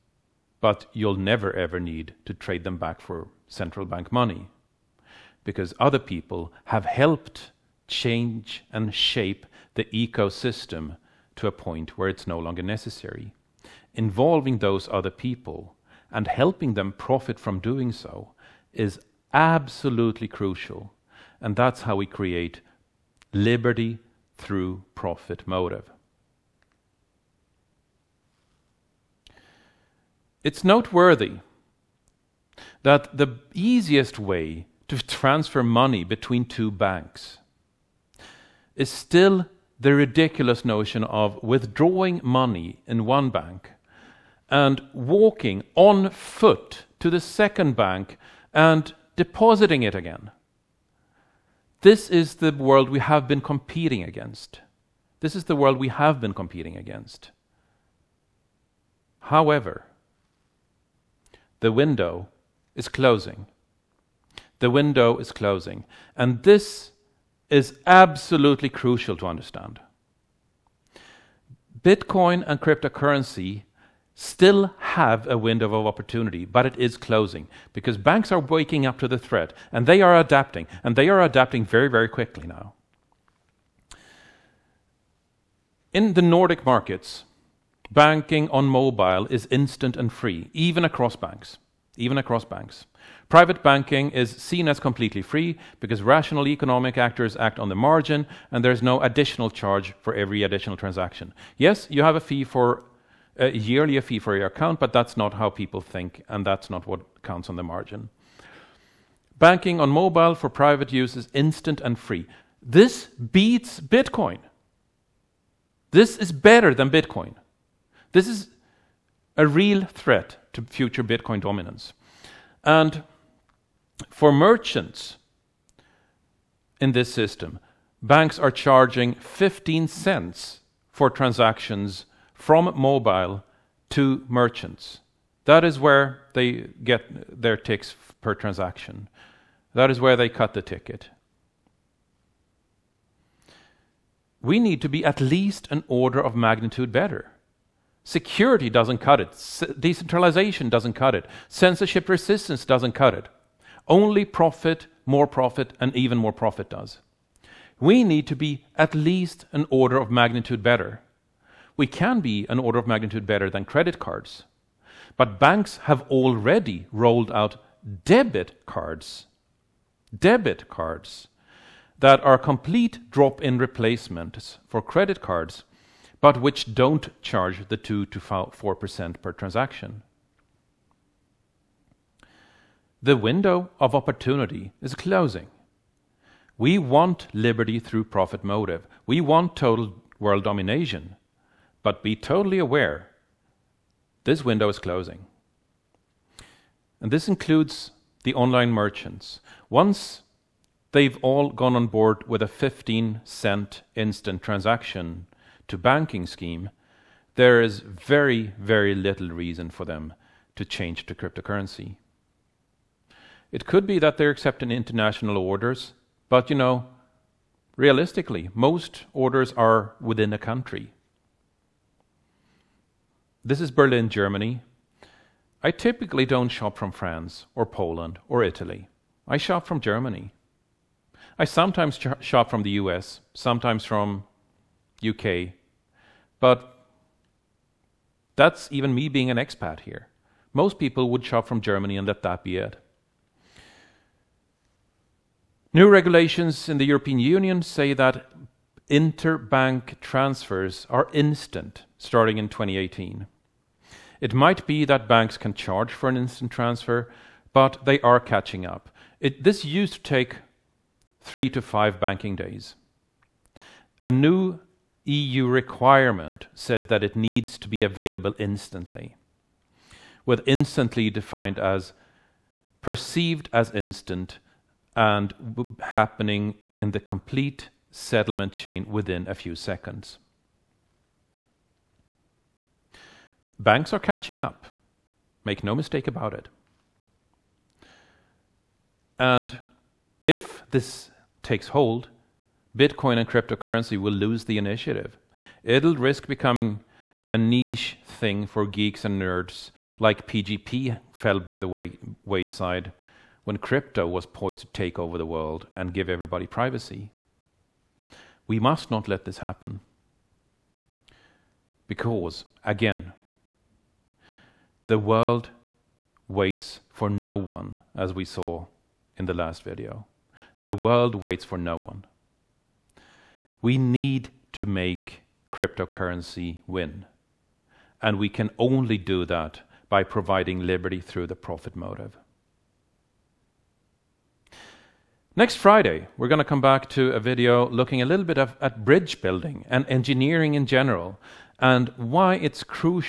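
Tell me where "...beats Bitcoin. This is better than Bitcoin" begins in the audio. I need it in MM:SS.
01:53.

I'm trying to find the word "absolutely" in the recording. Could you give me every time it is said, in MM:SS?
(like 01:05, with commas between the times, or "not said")
00:19, 01:07.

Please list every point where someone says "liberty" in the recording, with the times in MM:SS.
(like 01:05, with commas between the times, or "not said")
00:23, 03:07, 05:30.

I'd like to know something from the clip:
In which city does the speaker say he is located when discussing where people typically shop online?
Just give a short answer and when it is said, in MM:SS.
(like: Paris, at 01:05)
Berlin, at 03:43.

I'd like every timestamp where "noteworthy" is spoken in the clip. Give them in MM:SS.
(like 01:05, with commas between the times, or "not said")
00:30.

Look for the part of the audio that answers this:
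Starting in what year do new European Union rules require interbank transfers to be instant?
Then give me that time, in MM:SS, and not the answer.
04:12.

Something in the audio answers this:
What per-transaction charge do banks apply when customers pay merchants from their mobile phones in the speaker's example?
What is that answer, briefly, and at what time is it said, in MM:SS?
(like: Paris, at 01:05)
15 cents, at 02:09.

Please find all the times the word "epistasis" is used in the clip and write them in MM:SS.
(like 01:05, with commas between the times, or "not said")
not said.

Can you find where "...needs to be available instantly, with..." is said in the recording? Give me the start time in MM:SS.
04:27.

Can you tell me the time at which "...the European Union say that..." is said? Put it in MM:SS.
04:06.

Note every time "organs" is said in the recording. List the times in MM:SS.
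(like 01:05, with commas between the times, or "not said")
not said.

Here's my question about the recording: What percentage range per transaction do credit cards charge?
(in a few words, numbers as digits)
2 to 4%.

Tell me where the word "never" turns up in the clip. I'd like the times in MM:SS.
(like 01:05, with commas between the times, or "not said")
00:01.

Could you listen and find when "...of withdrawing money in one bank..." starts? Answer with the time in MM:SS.
00:41.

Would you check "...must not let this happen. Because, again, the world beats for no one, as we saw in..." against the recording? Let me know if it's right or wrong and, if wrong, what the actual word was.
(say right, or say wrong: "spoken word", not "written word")
wrong: "waits", not "beats".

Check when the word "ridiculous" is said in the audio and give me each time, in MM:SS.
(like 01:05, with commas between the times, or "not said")
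00:39.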